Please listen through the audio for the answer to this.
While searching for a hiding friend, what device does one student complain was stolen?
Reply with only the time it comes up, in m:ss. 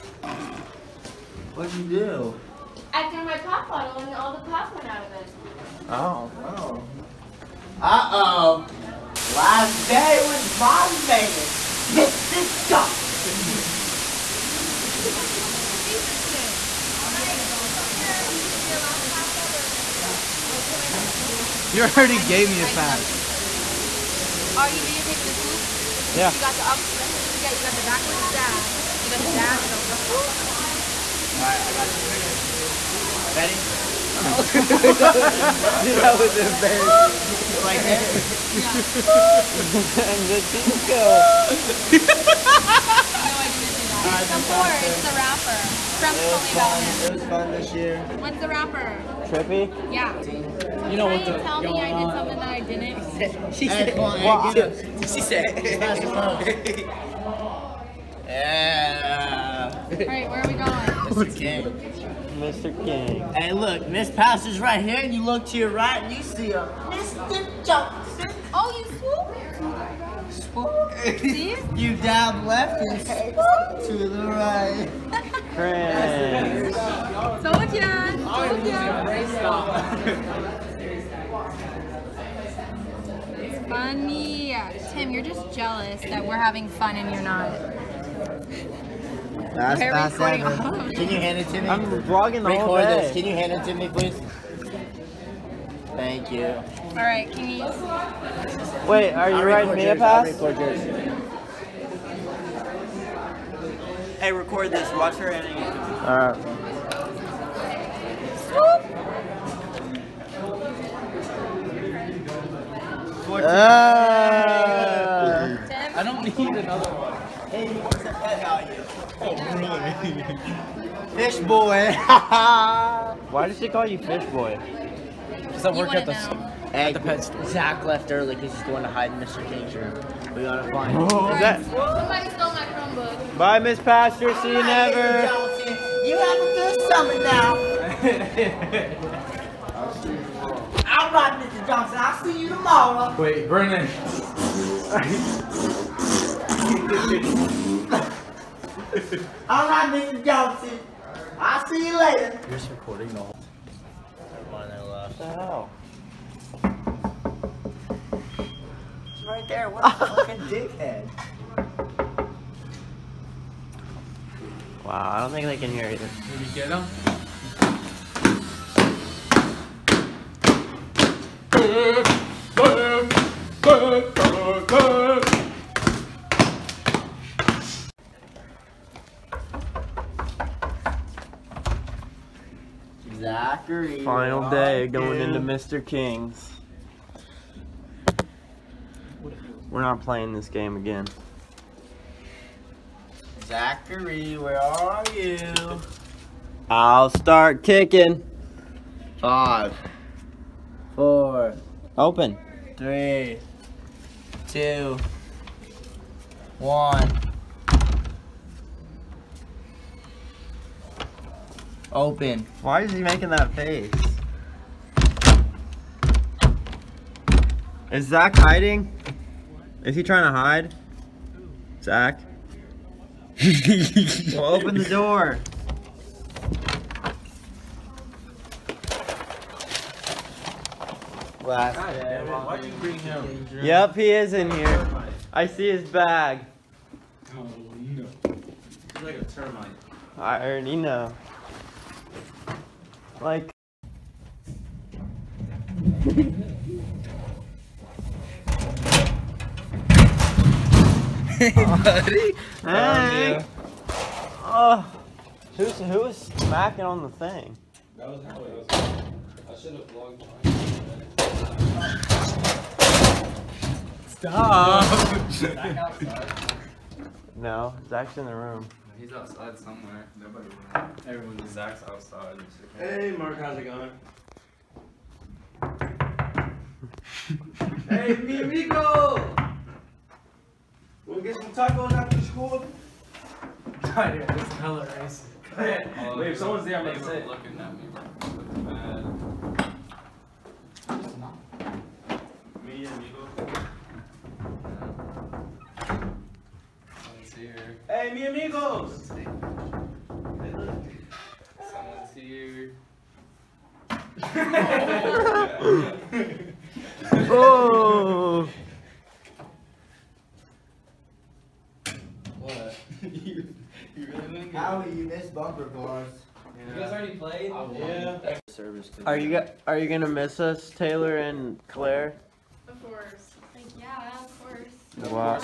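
2:12.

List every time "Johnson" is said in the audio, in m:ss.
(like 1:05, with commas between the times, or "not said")
0:12, 1:07, 2:21, 2:30.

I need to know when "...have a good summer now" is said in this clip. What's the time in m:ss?
2:16.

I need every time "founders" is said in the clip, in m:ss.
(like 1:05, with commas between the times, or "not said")
not said.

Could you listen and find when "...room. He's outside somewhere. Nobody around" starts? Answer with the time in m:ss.
4:28.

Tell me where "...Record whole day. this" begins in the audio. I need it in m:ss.
1:32.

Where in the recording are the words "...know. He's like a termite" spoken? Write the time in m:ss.
3:58.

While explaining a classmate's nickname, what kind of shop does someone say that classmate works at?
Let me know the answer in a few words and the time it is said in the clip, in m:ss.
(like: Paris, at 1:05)
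pet store, at 2:06.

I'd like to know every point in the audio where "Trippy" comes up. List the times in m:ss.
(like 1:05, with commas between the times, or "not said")
0:49.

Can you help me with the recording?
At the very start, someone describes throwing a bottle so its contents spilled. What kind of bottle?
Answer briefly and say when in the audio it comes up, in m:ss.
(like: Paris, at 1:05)
pop bottle, at 0:03.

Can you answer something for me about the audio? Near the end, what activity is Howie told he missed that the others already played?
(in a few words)
bumper cars.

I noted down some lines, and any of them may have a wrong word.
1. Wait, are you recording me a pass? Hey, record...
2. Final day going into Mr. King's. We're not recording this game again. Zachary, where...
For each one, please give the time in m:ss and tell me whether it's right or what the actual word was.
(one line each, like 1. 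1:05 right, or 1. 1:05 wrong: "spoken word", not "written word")
1. 1:38 wrong: "writing", not "recording"
2. 3:04 wrong: "playing", not "recording".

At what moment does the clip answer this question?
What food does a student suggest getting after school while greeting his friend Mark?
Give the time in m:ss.
4:41.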